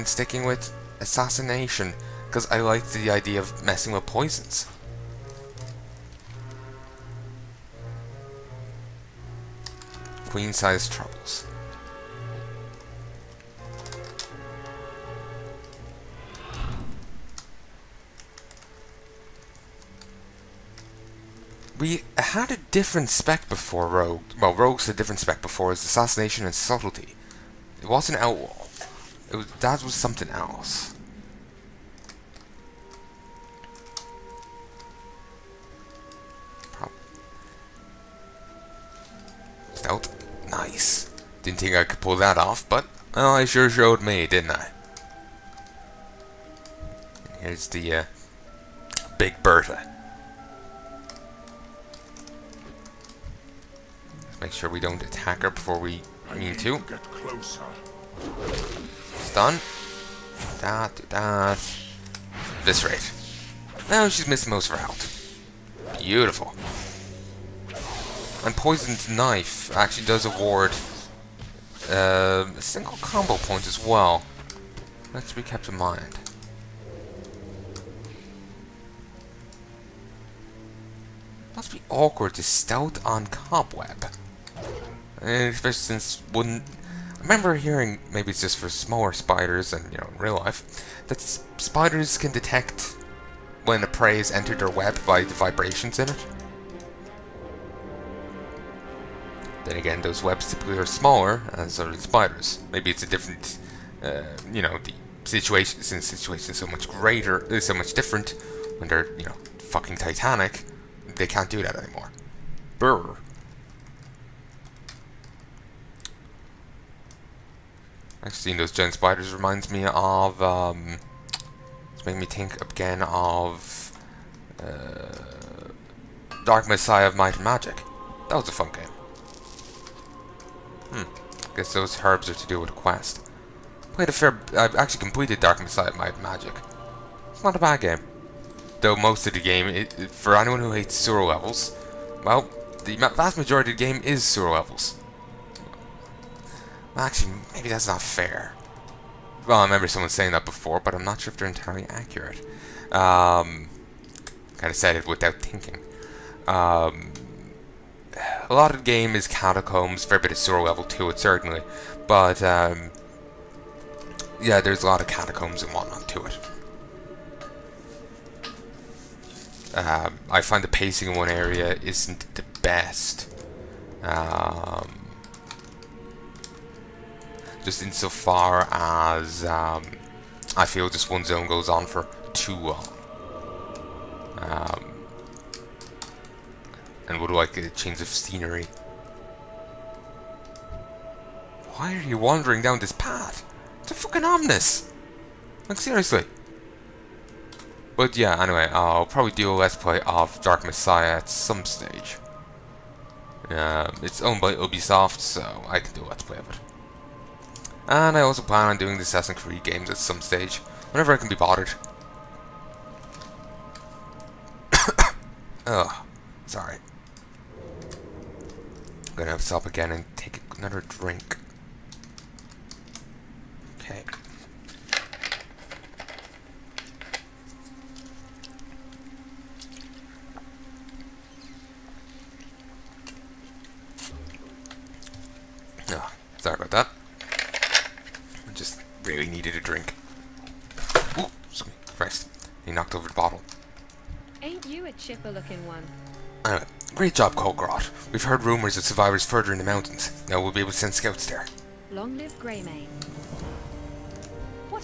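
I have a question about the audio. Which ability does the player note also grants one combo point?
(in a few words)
Poisoned knife.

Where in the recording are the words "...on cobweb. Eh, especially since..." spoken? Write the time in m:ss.
1:23.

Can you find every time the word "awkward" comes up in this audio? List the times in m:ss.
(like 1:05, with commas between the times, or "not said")
1:21.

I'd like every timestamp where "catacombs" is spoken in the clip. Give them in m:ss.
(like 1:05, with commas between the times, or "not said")
2:39, 2:45.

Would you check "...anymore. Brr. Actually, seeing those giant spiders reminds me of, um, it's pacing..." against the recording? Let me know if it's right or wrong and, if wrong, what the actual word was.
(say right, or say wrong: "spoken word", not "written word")
wrong: "making", not "pacing".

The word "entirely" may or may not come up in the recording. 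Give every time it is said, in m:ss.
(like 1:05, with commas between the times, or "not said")
2:31.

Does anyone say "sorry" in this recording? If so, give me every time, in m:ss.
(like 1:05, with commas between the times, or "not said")
3:36, 3:56.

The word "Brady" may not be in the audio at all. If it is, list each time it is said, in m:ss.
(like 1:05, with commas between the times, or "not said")
not said.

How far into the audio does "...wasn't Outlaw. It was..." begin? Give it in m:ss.
0:27.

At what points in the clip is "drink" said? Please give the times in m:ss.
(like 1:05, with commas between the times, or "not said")
3:40, 3:59.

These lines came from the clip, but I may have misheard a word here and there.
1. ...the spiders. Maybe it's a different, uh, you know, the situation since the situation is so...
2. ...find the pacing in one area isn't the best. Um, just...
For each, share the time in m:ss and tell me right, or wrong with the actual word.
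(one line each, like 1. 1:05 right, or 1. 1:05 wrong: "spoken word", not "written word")
1. 1:41 right
2. 2:50 right.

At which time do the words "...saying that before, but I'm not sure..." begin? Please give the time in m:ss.
2:30.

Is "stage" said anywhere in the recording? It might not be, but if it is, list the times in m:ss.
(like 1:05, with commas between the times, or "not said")
3:21, 3:30.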